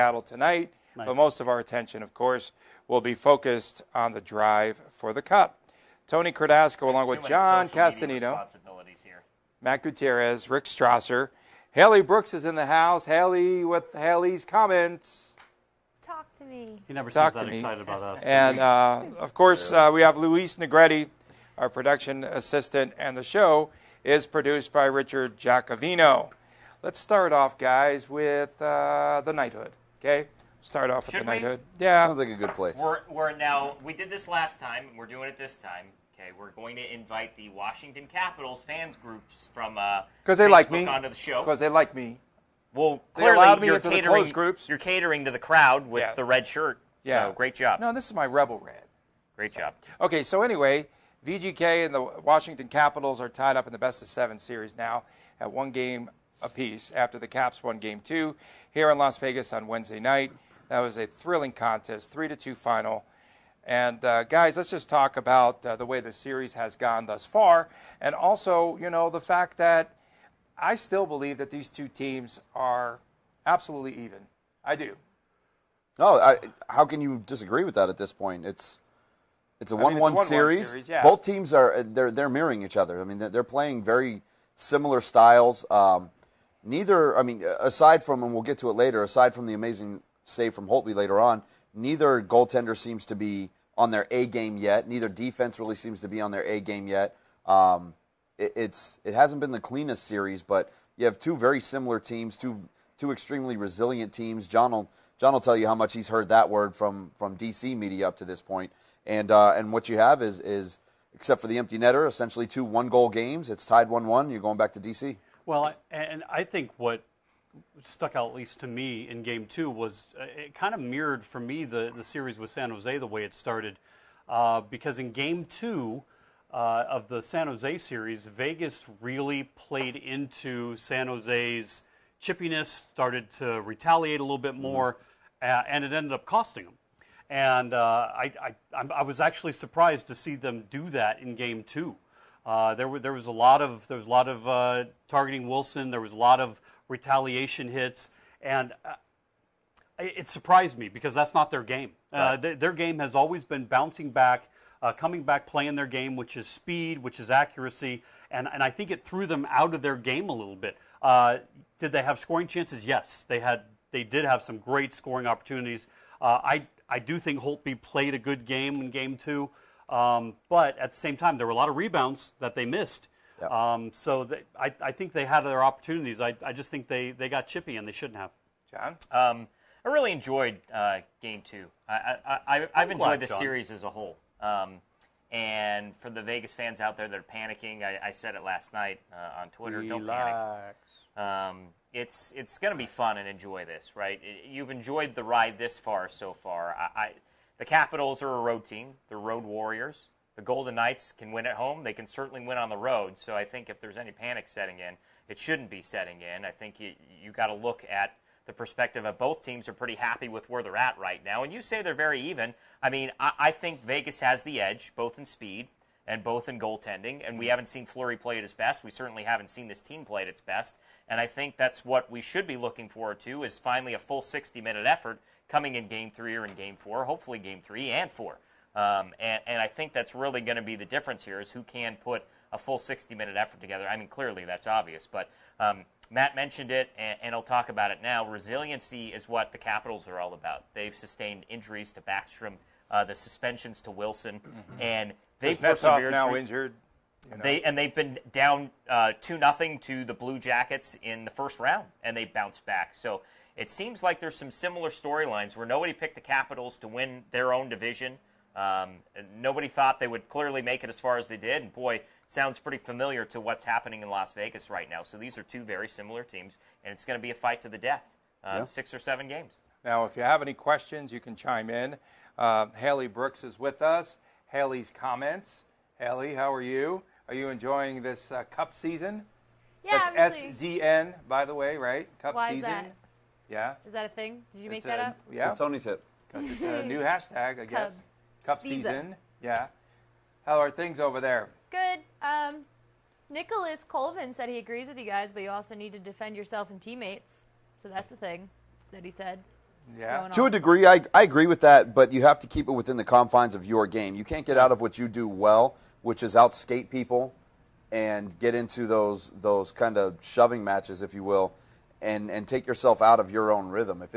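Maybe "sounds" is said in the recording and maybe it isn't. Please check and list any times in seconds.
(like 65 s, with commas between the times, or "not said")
32 s, 262 s.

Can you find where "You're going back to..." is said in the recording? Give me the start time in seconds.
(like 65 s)
114 s.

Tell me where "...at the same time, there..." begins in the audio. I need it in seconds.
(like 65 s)
170 s.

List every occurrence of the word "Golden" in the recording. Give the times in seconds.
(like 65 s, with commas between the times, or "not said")
200 s.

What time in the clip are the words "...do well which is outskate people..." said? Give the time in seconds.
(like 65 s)
305 s.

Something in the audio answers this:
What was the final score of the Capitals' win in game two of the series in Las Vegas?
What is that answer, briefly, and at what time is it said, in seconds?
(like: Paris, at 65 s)
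3 to 2, at 62 s.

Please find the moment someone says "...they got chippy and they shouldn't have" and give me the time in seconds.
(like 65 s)
177 s.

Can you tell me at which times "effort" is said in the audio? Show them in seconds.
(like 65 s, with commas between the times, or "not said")
224 s, 233 s.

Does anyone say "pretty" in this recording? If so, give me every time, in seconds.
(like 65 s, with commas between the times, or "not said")
209 s, 262 s.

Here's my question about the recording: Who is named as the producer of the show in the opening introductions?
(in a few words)
Richard Giacovino.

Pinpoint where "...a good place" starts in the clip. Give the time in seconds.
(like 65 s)
32 s.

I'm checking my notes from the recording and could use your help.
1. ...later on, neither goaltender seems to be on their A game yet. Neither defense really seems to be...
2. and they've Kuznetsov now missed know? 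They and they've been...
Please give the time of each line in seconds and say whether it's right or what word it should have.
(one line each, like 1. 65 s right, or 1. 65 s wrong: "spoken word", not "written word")
1. 90 s right
2. 244 s wrong: "injured", not "missed".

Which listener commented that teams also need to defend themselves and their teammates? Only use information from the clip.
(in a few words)
Nicholas Colvin.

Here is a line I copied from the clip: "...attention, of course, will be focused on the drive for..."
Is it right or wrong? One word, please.
right.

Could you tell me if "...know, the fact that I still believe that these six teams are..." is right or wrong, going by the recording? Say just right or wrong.
wrong.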